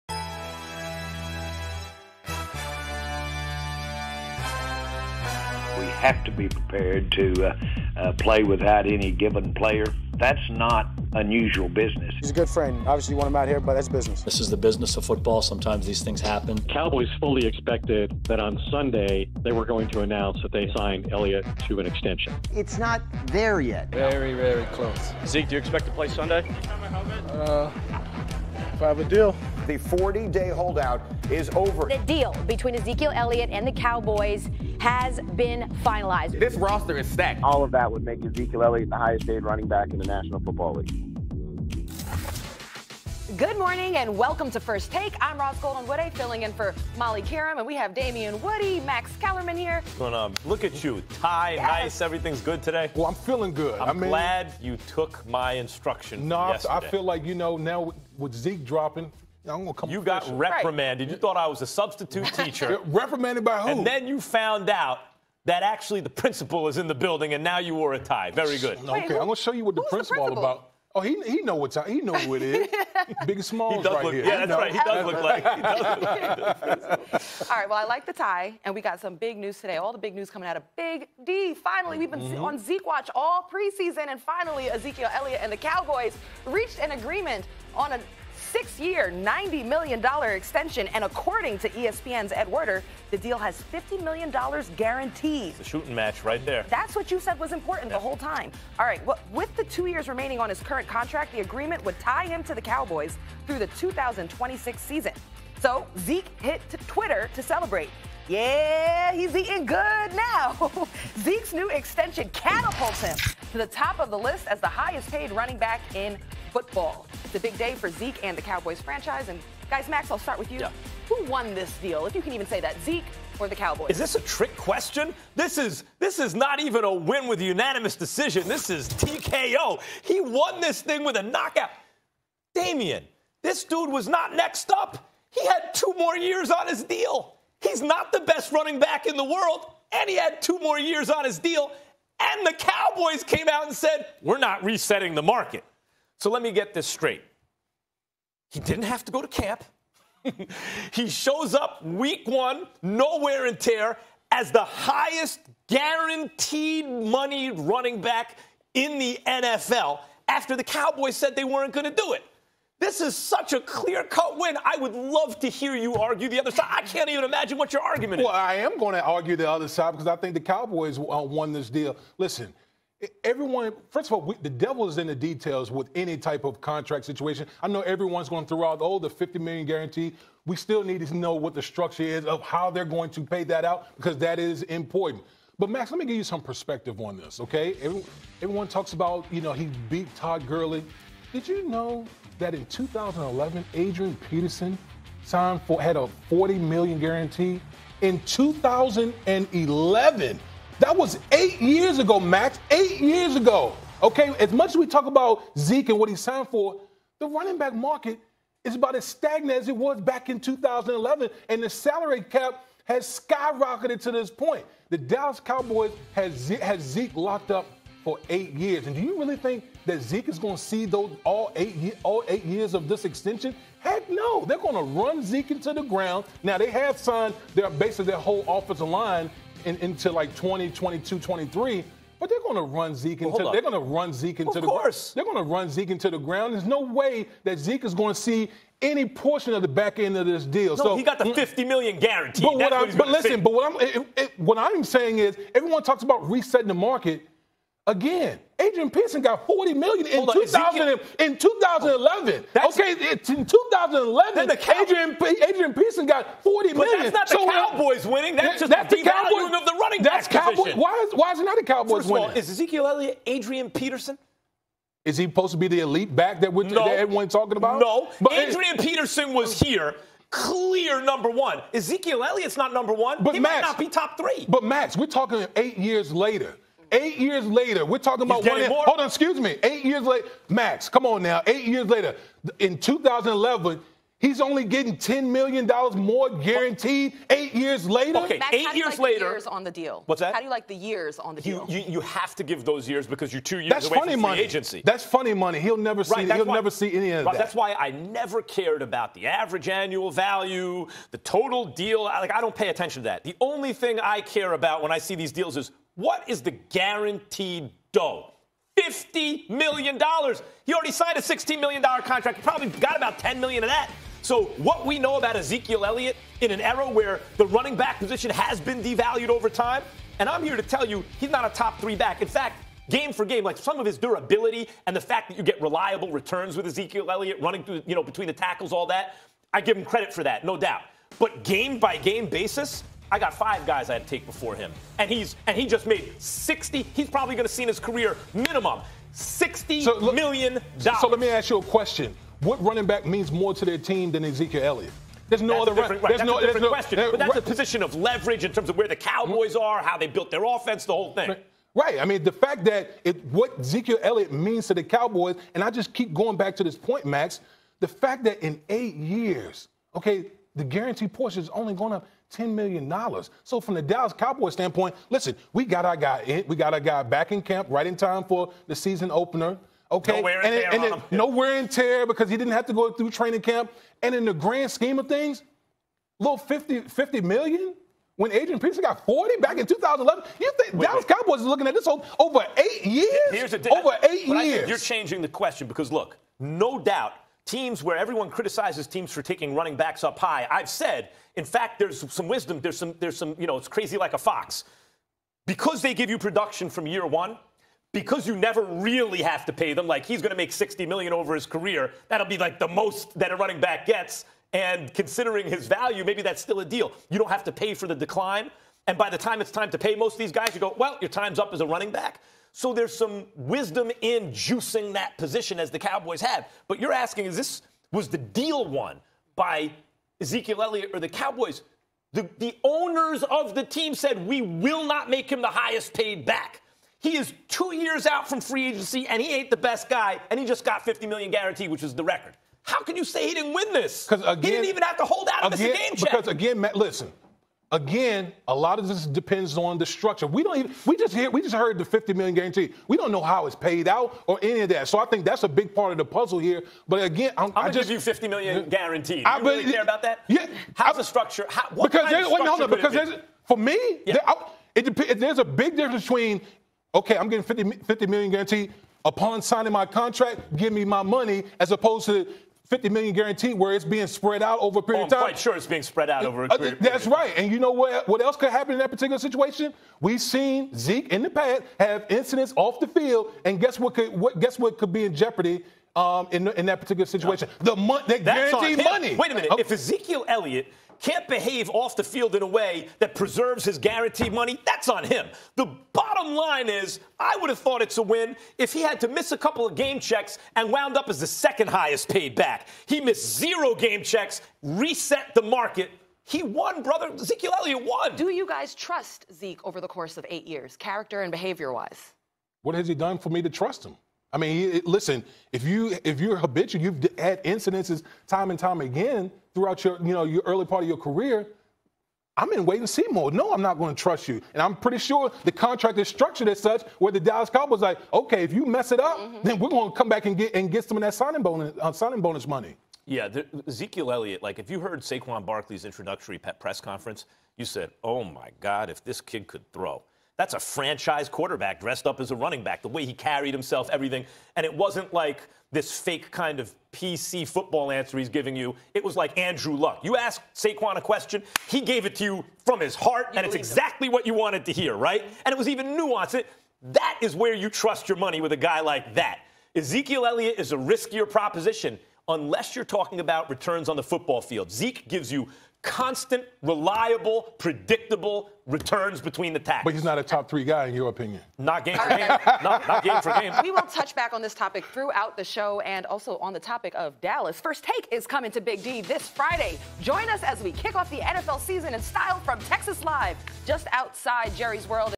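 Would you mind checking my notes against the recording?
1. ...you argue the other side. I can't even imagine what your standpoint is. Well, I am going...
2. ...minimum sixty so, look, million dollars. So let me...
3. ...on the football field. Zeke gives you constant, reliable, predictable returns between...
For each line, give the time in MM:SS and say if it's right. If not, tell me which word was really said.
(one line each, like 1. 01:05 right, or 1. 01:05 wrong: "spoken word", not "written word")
1. 02:45 wrong: "argument", not "standpoint"
2. 05:38 right
3. 09:13 right.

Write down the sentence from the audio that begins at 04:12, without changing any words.
okay, in 2011, the Cow- Adrian, Adrian Peterson got 40 but million.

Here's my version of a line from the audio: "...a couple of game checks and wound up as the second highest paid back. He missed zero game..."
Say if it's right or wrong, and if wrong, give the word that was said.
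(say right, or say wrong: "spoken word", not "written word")
right.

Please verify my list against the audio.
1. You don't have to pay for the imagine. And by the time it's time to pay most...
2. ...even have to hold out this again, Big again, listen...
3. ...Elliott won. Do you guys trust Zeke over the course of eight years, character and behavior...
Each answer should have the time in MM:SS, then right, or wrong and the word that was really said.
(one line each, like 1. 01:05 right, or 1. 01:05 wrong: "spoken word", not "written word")
1. 06:47 wrong: "decline", not "imagine"
2. 07:14 wrong: "Because", not "Big"
3. 08:17 right.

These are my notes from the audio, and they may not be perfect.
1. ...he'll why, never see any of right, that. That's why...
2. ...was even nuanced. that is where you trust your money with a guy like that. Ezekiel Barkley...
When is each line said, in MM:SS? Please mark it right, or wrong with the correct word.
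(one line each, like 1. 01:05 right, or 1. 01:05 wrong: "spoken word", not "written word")
1. 04:56 right
2. 09:05 wrong: "Elliott", not "Barkley".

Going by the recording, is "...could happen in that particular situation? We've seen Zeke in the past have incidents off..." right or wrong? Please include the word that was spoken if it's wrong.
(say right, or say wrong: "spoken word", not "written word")
right.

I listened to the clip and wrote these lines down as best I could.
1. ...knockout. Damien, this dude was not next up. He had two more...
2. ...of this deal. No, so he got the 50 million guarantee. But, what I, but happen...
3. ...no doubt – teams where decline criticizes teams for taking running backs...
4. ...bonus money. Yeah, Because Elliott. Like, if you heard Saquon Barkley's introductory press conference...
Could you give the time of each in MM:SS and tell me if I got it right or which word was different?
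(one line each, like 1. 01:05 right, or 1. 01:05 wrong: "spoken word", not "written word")
1. 02:11 right
2. 04:00 wrong: "listen", not "happen"
3. 06:26 wrong: "everyone", not "decline"
4. 08:42 wrong: "Ezekiel", not "Because".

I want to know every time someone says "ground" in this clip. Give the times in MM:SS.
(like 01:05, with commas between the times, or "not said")
03:45, 03:56.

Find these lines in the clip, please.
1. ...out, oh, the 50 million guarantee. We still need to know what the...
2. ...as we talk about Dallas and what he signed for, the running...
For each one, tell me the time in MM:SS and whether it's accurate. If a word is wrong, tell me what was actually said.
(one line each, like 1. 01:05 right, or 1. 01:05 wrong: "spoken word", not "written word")
1. 02:58 right
2. 03:24 wrong: "Zeke", not "Dallas".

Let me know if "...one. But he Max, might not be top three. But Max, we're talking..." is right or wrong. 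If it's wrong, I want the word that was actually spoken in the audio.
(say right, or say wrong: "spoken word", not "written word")
right.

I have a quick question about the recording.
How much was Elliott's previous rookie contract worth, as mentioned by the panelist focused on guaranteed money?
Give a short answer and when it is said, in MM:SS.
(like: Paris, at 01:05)
$16 million, at 05:11.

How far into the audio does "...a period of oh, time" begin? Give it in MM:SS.
07:44.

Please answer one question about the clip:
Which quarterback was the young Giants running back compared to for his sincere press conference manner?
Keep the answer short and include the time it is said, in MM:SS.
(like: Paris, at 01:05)
Andrew Luck, at 08:59.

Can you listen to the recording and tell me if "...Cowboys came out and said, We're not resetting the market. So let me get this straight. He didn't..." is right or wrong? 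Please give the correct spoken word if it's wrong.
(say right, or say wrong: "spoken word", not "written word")
right.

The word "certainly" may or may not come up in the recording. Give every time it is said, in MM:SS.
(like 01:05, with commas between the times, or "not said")
not said.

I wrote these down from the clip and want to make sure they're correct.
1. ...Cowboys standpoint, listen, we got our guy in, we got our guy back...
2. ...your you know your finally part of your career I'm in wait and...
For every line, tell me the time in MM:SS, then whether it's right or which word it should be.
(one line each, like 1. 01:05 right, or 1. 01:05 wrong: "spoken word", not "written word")
1. 06:04 right
2. 08:29 wrong: "early", not "finally".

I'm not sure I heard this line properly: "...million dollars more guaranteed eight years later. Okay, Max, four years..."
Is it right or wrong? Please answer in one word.
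wrong.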